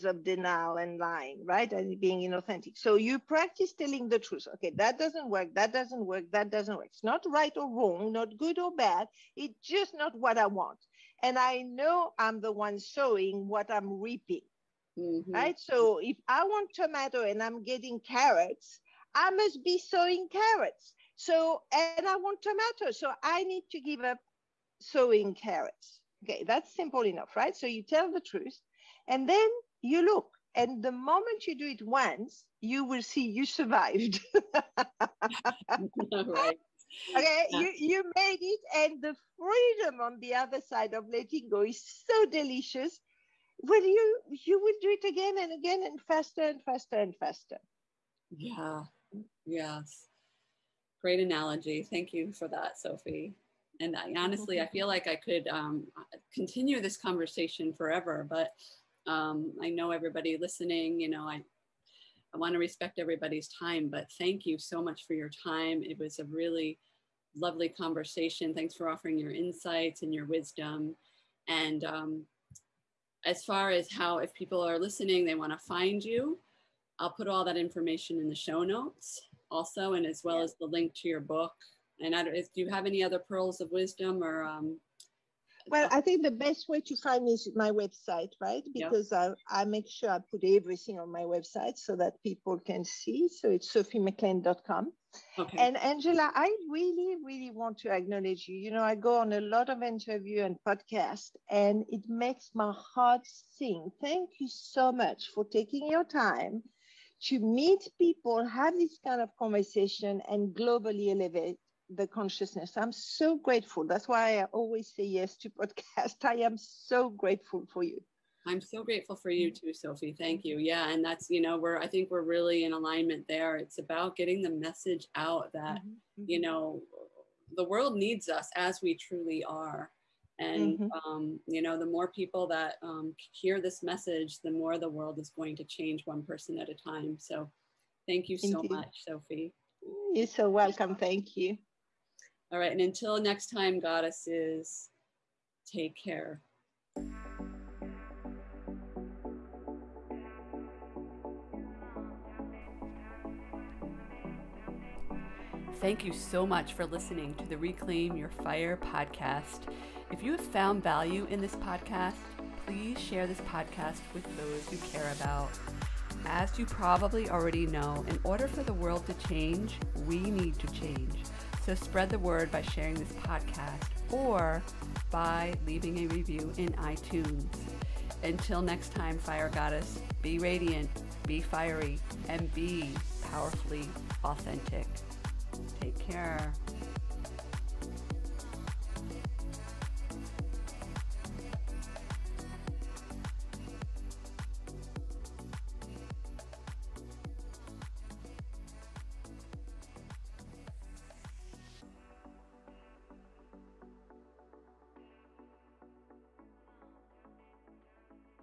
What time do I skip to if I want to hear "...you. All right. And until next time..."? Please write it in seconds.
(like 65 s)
141 s.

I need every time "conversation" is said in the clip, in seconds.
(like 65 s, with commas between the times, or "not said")
56 s, 67 s, 109 s.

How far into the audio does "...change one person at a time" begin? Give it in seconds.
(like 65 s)
135 s.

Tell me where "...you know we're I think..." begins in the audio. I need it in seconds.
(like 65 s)
121 s.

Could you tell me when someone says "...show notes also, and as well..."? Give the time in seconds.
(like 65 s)
78 s.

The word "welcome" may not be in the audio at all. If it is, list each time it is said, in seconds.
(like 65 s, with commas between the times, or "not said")
140 s.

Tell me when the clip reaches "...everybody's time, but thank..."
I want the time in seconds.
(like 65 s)
62 s.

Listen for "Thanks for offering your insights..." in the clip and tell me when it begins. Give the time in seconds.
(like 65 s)
68 s.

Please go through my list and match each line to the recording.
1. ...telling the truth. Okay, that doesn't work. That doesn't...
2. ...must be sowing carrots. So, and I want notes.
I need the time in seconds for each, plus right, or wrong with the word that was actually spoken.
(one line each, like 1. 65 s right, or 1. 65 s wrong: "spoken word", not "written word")
1. 3 s right
2. 19 s wrong: "tomatoes", not "notes".